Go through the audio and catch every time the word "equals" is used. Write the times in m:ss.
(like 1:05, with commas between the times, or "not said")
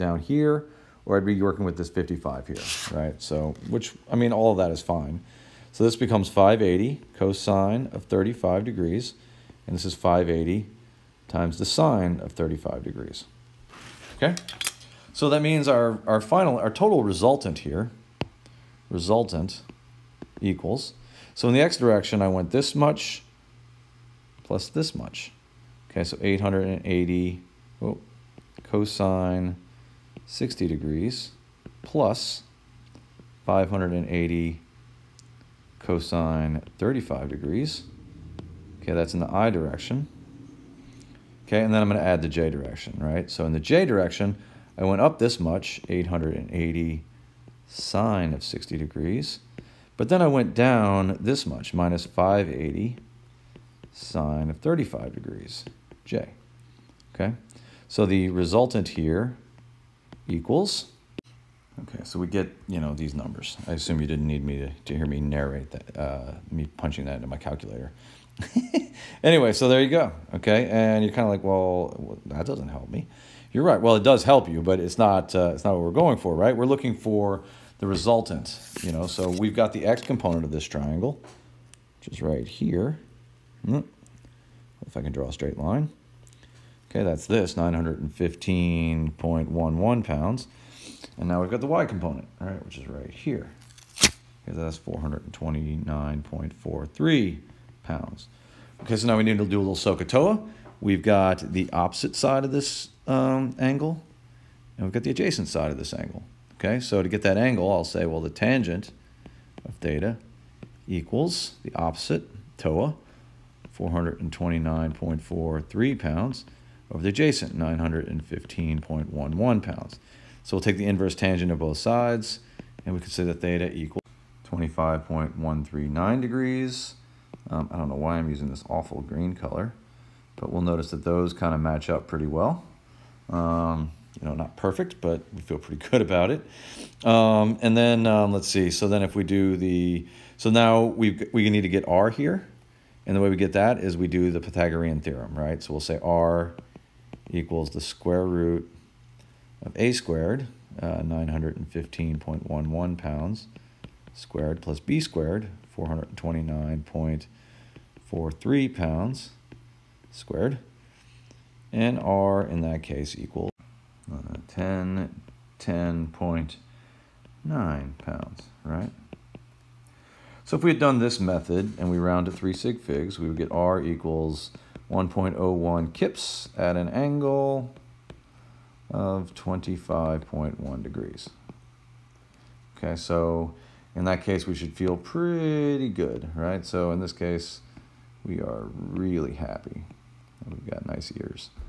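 0:20, 1:00, 1:50, 2:03, 2:27, 2:43, 2:53.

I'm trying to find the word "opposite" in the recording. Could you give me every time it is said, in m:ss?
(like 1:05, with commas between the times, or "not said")
1:41, 1:51.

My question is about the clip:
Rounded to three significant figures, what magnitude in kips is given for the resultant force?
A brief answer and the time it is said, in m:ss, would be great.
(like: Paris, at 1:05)
1.01 kips, at 2:54.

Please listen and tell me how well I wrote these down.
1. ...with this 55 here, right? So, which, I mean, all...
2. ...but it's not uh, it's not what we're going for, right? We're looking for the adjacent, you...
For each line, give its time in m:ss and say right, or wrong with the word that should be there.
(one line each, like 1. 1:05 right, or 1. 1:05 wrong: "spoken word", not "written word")
1. 0:01 right
2. 1:14 wrong: "resultant", not "adjacent".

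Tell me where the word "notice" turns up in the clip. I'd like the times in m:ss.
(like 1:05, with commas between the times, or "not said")
2:10.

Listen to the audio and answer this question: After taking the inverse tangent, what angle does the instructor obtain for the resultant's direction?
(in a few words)
25.139 degrees.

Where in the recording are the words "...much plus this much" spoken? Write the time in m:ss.
0:22.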